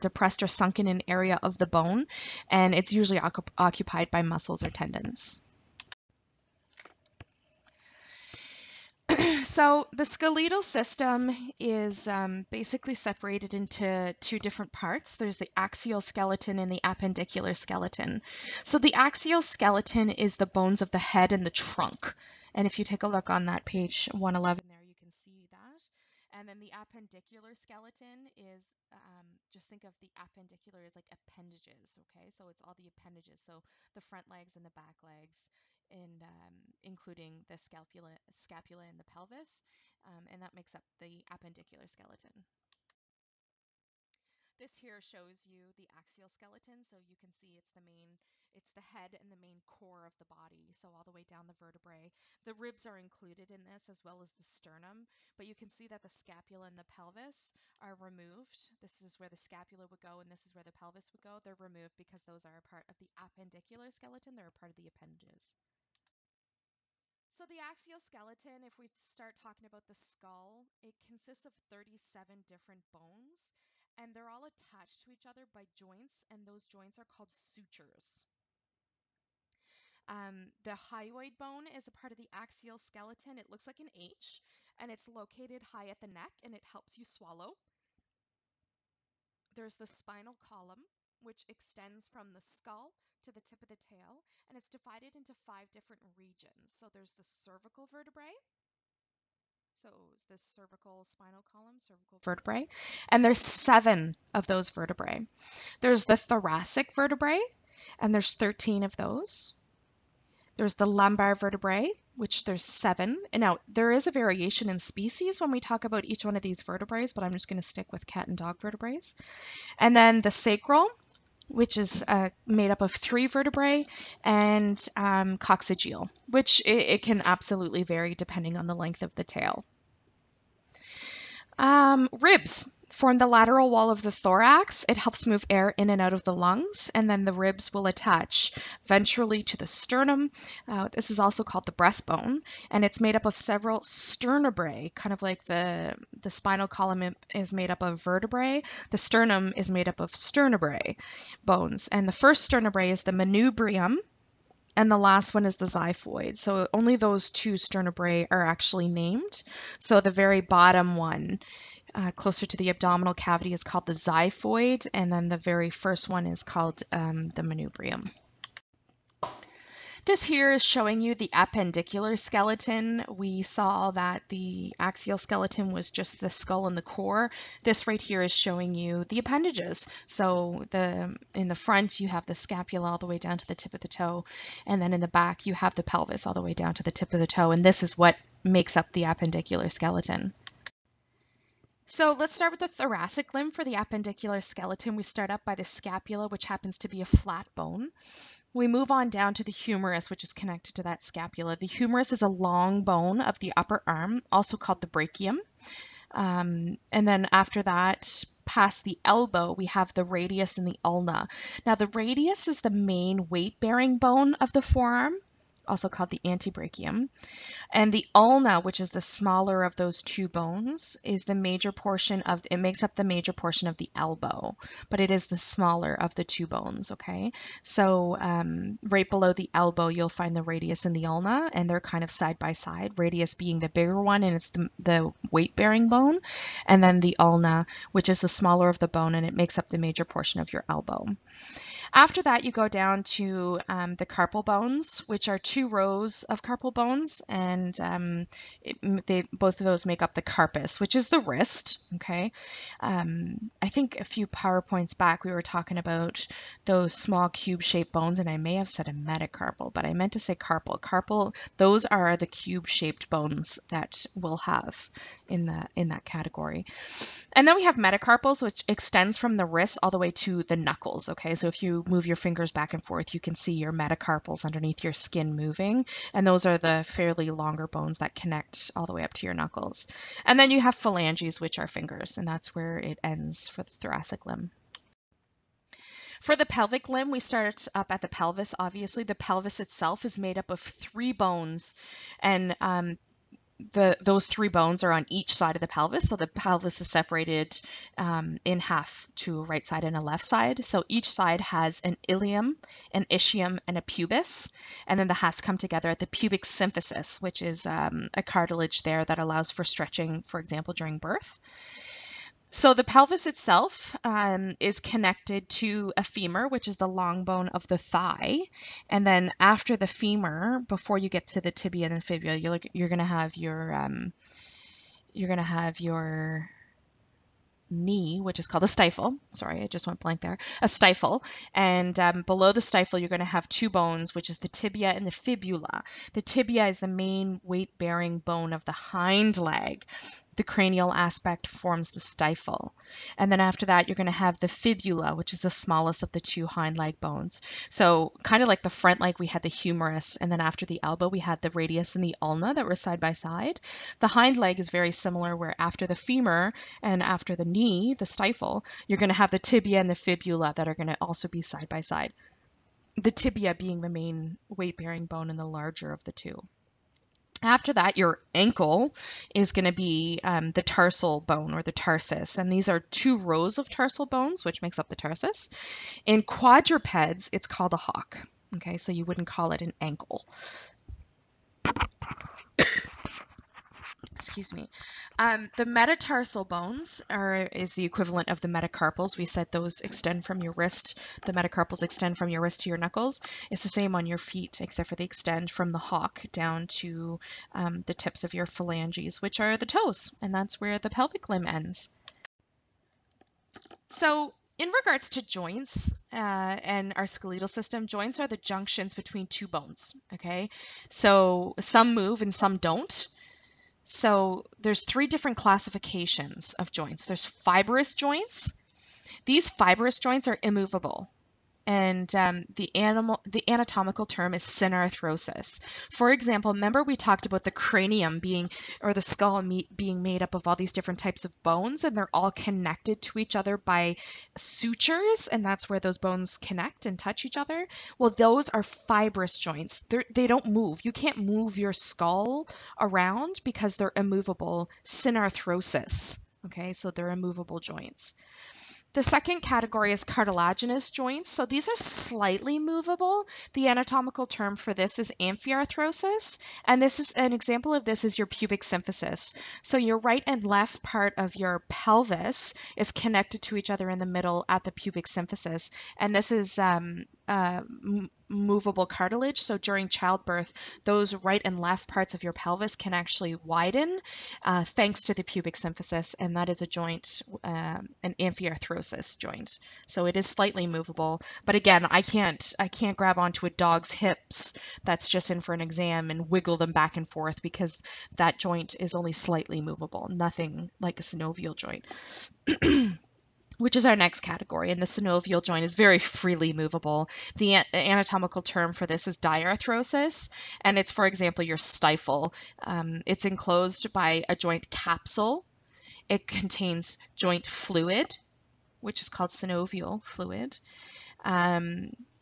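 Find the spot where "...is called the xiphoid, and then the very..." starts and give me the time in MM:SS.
02:43.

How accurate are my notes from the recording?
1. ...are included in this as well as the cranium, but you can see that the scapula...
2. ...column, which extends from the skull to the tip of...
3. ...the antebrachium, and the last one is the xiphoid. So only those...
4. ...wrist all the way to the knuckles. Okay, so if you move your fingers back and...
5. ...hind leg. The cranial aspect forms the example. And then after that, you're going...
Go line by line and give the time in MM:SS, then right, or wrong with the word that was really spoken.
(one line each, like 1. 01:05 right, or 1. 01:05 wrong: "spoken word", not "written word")
1. 00:52 wrong: "sternum", not "cranium"
2. 01:30 right
3. 02:33 wrong: "manubrium", not "antebrachium"
4. 04:29 right
5. 05:38 wrong: "stifle", not "example".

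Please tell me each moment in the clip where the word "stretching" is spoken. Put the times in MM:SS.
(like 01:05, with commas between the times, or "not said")
05:09.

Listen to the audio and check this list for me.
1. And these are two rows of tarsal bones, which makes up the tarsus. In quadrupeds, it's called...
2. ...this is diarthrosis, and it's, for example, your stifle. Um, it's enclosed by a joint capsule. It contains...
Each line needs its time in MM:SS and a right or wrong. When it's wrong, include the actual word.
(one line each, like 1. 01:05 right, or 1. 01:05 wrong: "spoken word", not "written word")
1. 06:12 right
2. 08:18 right.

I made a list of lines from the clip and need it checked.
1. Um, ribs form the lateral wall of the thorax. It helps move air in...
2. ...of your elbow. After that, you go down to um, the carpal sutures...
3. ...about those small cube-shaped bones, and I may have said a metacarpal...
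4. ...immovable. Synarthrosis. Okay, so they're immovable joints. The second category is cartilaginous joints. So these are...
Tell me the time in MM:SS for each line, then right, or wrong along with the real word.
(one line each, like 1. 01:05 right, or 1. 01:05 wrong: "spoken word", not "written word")
1. 02:11 right
2. 04:00 wrong: "bones", not "sutures"
3. 04:15 right
4. 07:23 right.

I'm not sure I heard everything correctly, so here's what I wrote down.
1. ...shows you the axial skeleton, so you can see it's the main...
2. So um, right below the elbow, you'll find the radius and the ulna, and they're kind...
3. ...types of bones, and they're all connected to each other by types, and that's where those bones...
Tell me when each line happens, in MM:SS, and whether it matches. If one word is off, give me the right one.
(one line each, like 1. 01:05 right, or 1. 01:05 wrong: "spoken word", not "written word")
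1. 00:44 right
2. 03:47 right
3. 07:10 wrong: "sutures", not "types".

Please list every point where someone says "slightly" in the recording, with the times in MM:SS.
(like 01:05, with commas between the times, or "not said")
07:31, 08:00, 08:09.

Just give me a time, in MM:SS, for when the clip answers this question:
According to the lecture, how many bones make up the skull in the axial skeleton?
01:11.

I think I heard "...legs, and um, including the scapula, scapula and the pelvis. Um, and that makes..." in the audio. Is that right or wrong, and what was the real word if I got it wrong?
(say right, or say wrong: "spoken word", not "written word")
right.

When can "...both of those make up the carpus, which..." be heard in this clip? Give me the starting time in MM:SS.
04:09.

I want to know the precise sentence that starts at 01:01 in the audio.
They're removed because those are a part of the appendicular skeleton, they're a part of the appendages.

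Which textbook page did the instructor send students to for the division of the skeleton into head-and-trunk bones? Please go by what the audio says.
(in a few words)
111.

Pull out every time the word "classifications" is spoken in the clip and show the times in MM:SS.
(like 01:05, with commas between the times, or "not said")
06:55.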